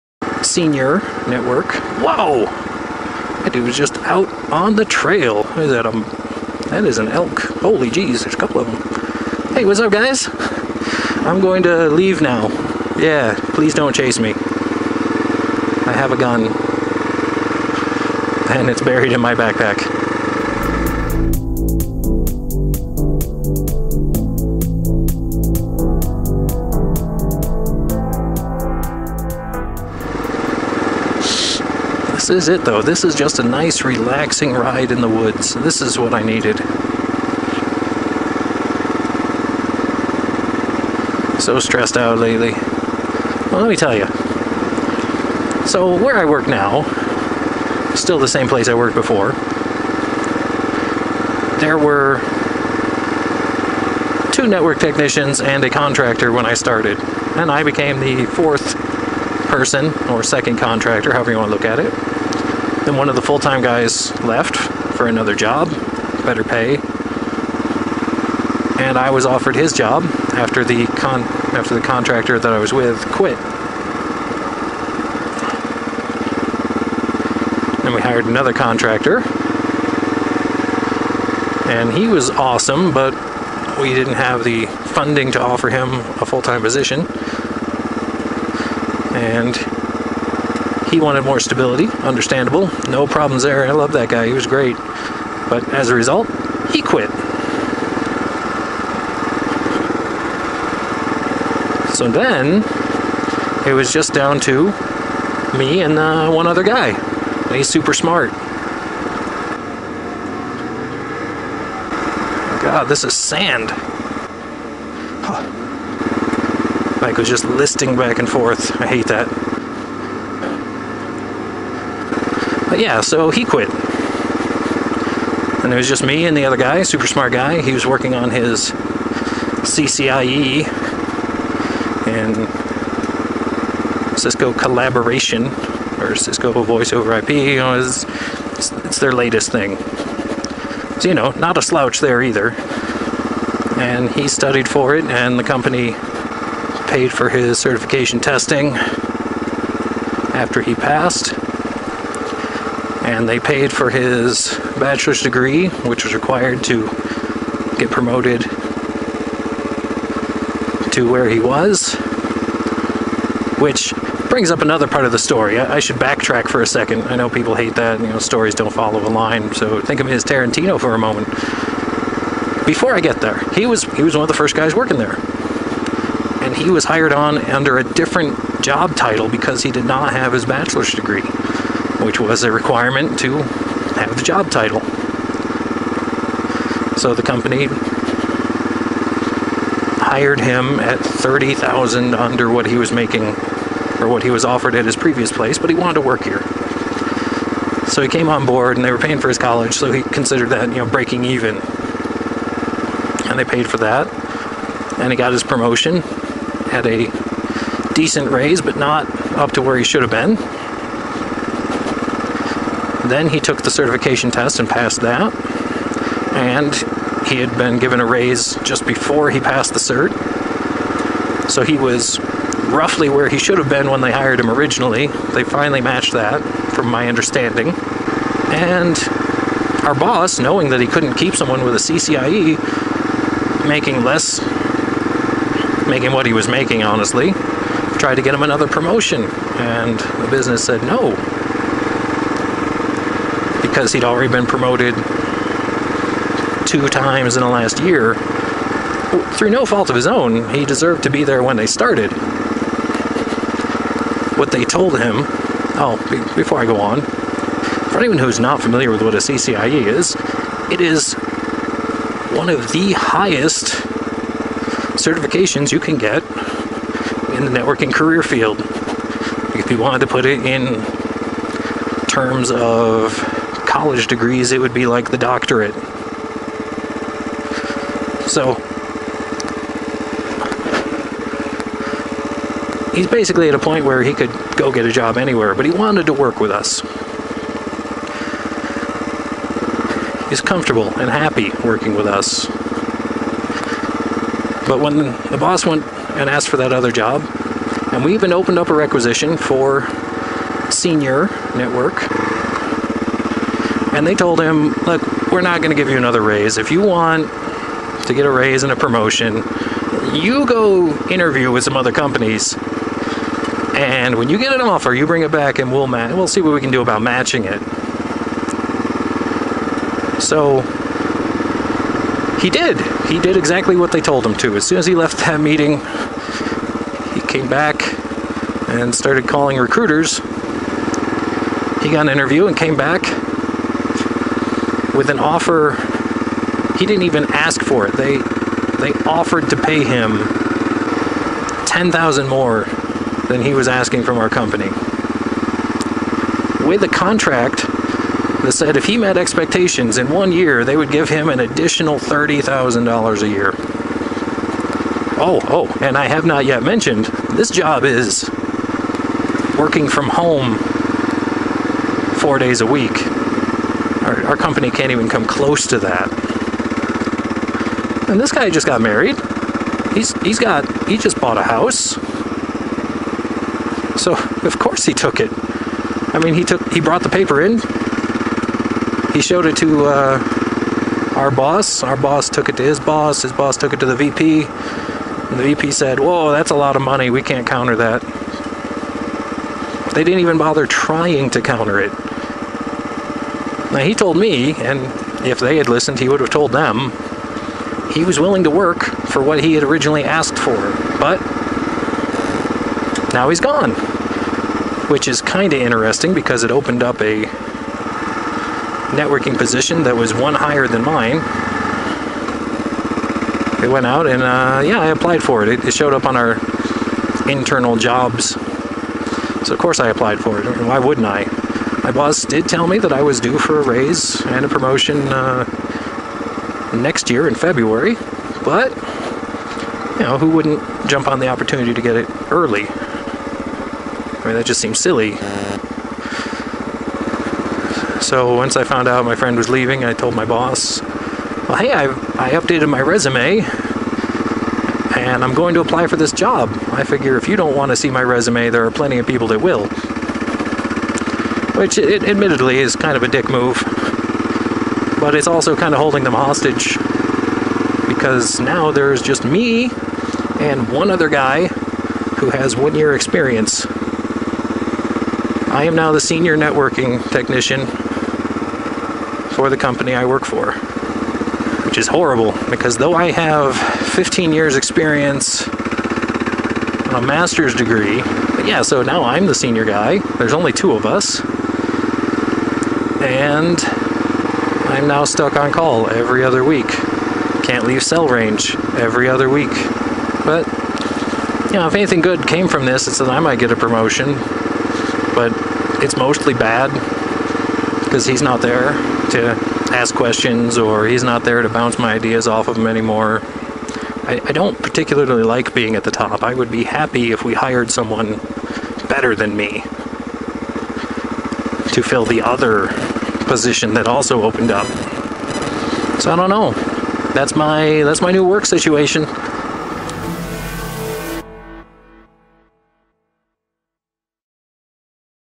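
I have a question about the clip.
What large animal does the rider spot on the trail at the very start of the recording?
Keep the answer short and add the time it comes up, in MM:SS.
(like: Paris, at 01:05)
elk, at 00:07.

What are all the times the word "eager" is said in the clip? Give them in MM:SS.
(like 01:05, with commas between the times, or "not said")
not said.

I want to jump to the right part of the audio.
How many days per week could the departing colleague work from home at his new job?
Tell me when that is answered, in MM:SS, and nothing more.
06:02.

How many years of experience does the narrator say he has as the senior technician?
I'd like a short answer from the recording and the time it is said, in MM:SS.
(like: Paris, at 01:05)
15, at 07:53.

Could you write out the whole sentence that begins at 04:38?
So, he's basically at a point where he could go get a job anywhere, but he wanted to work with us.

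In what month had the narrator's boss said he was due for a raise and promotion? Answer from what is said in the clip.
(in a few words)
February.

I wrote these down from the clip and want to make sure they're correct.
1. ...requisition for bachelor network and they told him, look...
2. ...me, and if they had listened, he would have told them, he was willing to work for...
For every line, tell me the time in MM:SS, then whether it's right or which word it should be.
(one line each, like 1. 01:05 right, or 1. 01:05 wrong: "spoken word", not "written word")
1. 04:58 wrong: "senior", not "bachelor"
2. 06:34 right.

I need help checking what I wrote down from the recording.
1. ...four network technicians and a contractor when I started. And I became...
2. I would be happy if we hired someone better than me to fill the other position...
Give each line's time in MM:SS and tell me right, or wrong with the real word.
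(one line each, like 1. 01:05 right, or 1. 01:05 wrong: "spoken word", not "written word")
1. 00:54 wrong: "two", not "four"
2. 08:26 right.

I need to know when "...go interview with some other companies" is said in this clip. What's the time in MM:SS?
05:10.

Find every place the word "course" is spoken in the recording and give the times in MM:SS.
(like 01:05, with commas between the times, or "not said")
06:14, 06:59.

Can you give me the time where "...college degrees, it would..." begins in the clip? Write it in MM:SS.
04:33.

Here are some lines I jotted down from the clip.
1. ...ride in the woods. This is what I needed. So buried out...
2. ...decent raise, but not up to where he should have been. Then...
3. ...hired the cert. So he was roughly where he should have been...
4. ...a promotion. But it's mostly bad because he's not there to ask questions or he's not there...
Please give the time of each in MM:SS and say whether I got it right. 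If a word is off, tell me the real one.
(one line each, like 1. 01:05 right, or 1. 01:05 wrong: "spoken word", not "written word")
1. 00:34 wrong: "stressed", not "buried"
2. 03:27 right
3. 03:39 wrong: "passed", not "hired"
4. 08:13 right.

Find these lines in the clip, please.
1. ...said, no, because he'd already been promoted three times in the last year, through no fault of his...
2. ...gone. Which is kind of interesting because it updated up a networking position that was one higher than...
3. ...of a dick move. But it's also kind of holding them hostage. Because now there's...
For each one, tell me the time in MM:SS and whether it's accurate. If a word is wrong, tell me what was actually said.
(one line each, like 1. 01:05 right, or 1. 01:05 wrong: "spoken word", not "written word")
1. 04:00 wrong: "two", not "three"
2. 06:43 wrong: "opened", not "updated"
3. 07:32 right.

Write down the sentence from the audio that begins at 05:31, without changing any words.
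He got an interview and came back with an offer he didn't even ask for it.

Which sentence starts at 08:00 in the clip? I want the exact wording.
There's only two of us and I'm now stuck on call every other week.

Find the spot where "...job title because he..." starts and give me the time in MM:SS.
02:58.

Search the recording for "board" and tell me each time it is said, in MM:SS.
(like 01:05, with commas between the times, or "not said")
03:18.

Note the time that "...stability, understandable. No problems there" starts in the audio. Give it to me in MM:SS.
01:31.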